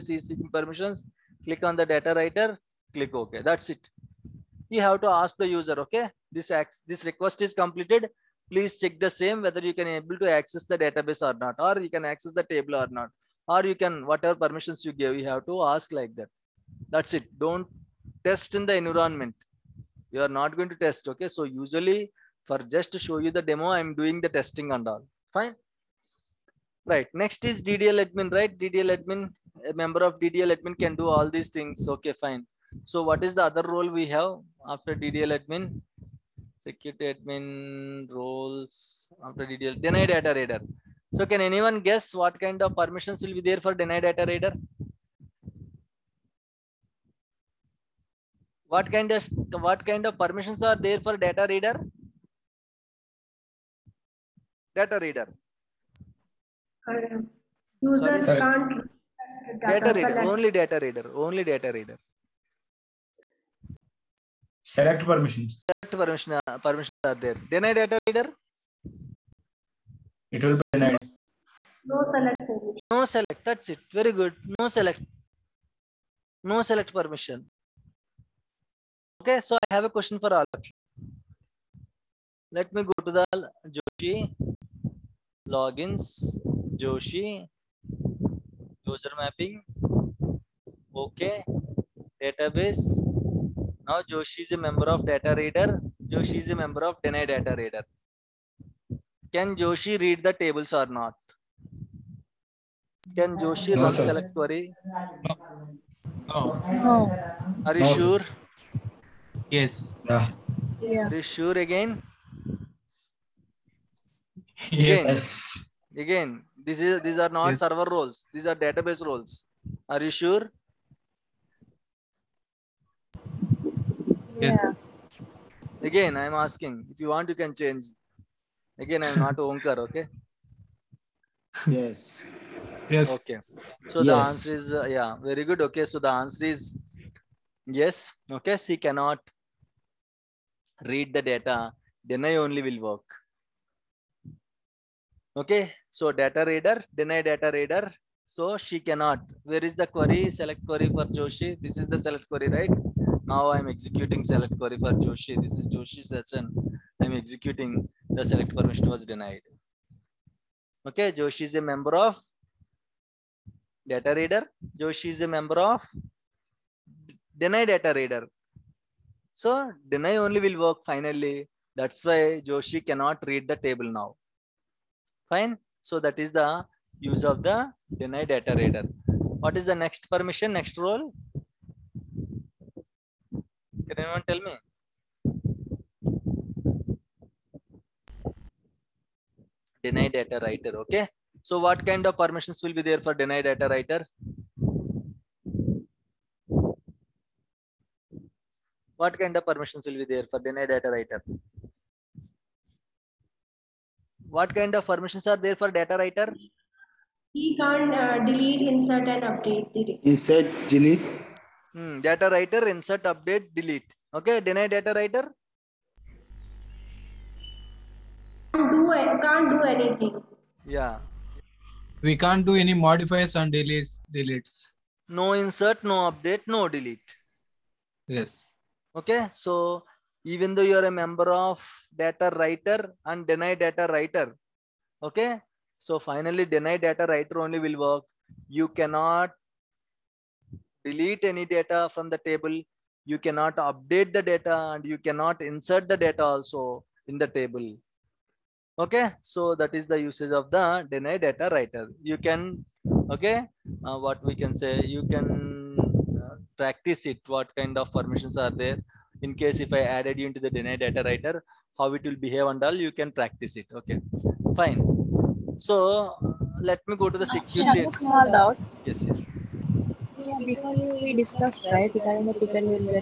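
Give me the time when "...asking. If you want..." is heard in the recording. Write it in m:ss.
2:06.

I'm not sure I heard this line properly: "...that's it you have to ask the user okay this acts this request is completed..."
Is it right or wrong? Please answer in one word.
right.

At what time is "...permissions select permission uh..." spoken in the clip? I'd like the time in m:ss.
1:05.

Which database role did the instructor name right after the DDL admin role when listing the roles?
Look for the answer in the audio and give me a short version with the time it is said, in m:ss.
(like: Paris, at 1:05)
Security admin, at 0:36.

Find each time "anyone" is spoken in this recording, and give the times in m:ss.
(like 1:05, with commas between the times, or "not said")
0:41, 3:03.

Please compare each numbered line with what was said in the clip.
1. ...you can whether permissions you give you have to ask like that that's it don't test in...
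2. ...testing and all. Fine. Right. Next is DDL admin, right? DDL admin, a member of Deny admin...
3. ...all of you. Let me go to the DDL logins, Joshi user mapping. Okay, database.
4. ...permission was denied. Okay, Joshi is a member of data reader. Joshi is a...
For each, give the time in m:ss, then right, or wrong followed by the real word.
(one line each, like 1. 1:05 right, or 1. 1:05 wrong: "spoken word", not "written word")
1. 0:13 wrong: "whatever", not "whether"
2. 0:24 wrong: "DDL", not "Deny"
3. 1:20 wrong: "Joshi", not "DDL"
4. 2:38 right.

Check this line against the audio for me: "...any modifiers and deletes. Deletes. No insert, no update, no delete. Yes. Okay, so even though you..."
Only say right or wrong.
right.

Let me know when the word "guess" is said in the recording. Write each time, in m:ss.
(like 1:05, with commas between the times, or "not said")
0:41.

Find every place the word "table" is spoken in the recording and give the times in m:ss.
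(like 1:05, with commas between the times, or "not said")
0:12, 1:40, 2:53, 4:02, 4:07.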